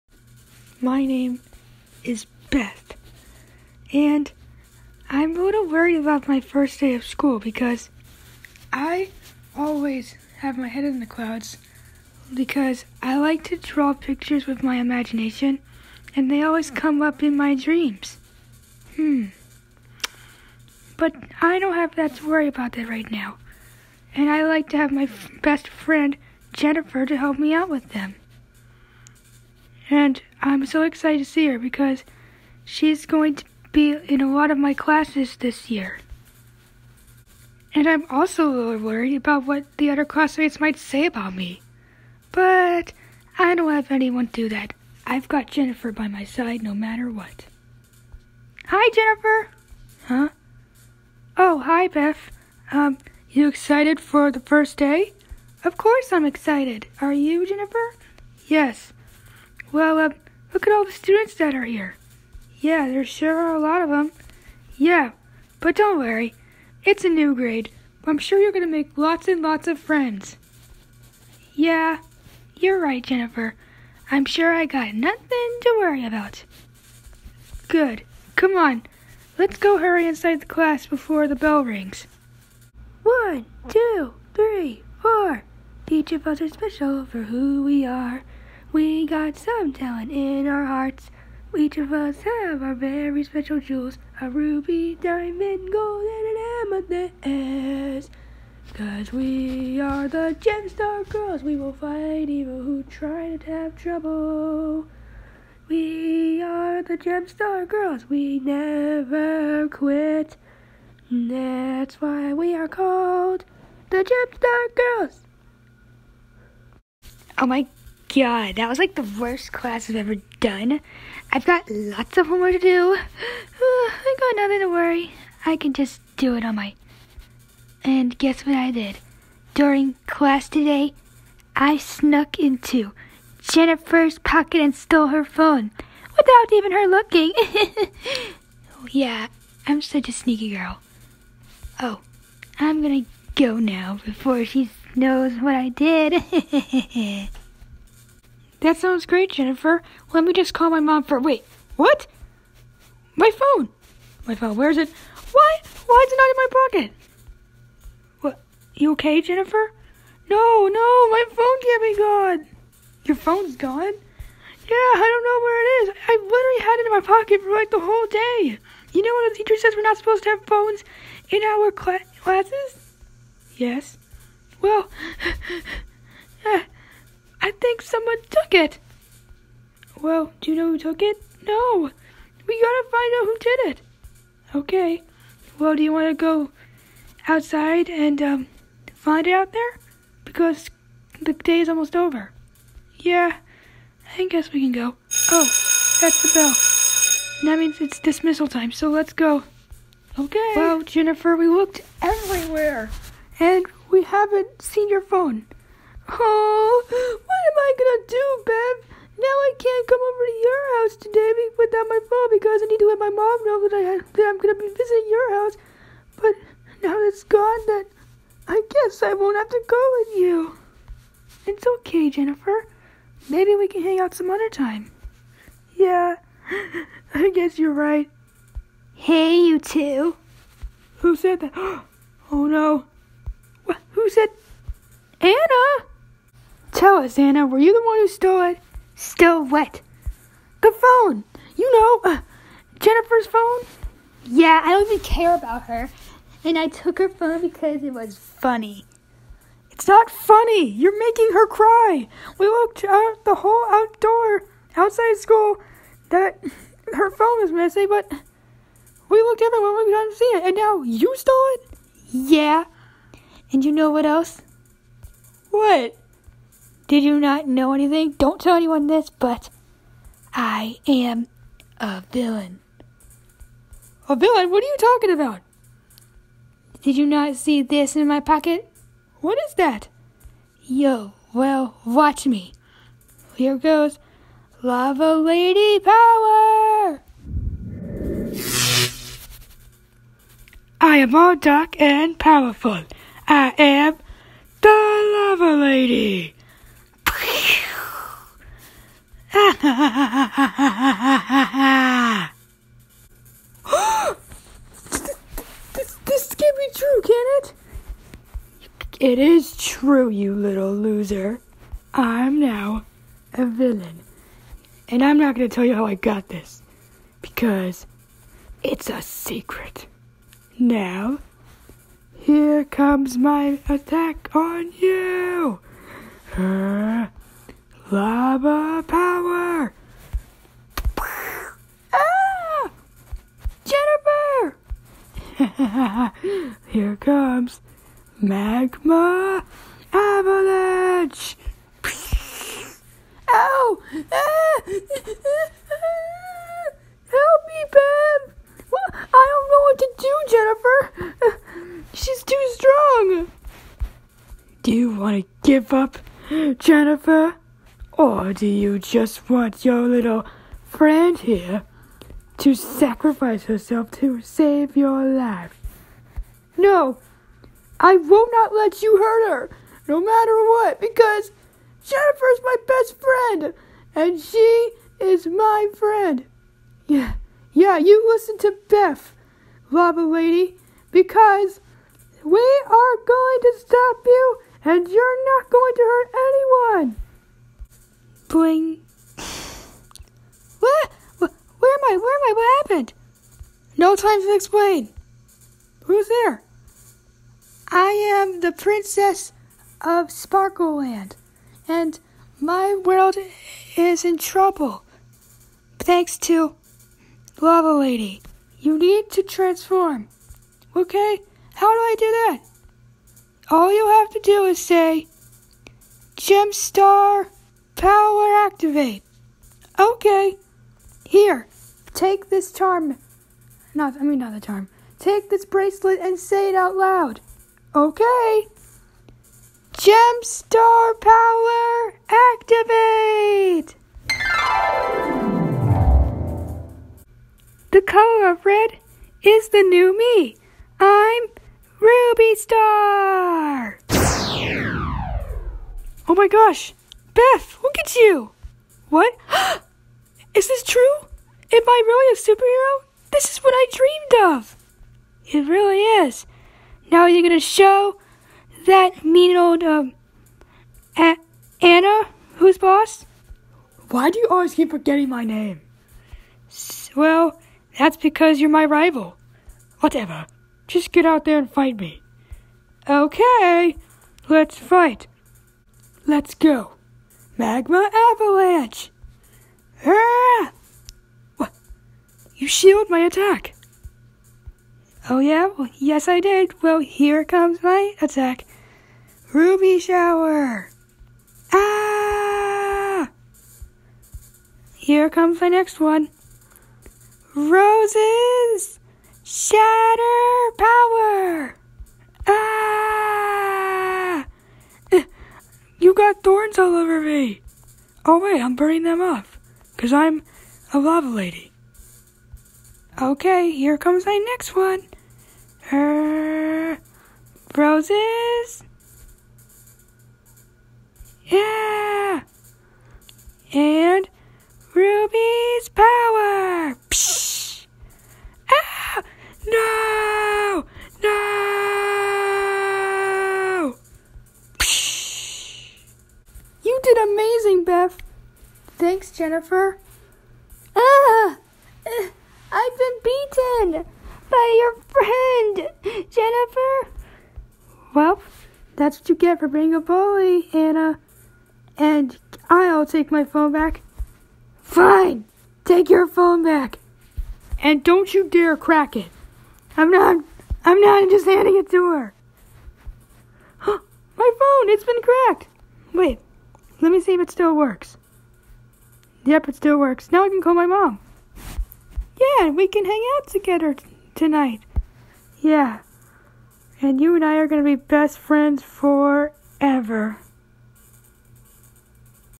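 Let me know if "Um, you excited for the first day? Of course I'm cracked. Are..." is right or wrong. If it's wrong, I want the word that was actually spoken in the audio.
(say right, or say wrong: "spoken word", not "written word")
wrong: "excited", not "cracked".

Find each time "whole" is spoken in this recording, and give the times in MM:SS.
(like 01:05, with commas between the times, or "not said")
02:47, 04:13.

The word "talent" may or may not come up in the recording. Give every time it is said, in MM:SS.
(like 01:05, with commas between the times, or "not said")
01:29.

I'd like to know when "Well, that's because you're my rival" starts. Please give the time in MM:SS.
07:46.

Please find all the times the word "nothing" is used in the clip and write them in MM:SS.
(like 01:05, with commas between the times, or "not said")
01:14, 02:04.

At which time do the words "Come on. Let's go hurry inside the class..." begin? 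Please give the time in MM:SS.
01:18.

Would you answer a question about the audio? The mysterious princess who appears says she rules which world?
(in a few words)
Sparkleland.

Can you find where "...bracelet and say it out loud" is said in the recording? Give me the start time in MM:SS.
07:05.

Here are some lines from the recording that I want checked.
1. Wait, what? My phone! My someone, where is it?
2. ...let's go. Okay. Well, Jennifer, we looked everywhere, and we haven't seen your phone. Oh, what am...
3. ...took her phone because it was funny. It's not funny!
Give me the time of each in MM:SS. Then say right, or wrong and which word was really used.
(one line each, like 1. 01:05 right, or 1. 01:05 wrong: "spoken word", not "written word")
1. 02:31 wrong: "phone", not "someone"
2. 03:18 right
3. 04:06 right.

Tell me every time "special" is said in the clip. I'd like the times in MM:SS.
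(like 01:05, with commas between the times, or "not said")
01:26, 01:33.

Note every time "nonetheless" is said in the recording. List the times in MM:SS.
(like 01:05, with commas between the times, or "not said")
not said.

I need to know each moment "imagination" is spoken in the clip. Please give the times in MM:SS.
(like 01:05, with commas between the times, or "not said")
00:14.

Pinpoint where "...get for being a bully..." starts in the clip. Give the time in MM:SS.
09:09.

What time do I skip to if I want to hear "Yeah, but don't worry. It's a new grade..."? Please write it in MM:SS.
01:04.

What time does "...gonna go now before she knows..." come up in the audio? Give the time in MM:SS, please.
02:22.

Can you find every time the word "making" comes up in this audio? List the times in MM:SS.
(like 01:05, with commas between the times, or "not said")
04:10.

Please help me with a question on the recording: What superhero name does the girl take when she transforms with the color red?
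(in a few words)
Ruby Star.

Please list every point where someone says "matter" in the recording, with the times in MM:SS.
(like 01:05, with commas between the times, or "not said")
00:46, 06:10.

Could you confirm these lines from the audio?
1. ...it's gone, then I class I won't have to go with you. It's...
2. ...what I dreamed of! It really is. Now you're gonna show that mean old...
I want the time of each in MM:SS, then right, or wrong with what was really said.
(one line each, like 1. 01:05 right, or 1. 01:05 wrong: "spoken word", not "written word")
1. 03:37 wrong: "guess", not "class"
2. 07:33 right.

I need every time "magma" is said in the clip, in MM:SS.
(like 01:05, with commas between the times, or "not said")
05:38, 07:57.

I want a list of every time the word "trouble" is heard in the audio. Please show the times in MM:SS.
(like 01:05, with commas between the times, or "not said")
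01:43, 06:44.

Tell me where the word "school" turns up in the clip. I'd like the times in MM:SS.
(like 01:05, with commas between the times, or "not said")
00:07, 04:15.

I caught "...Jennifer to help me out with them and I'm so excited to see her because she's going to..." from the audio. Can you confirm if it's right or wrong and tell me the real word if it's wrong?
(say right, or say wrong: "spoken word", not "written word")
right.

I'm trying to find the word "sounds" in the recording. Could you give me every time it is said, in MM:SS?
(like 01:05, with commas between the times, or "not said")
02:28.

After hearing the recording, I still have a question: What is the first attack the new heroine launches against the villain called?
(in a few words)
Ruby shower.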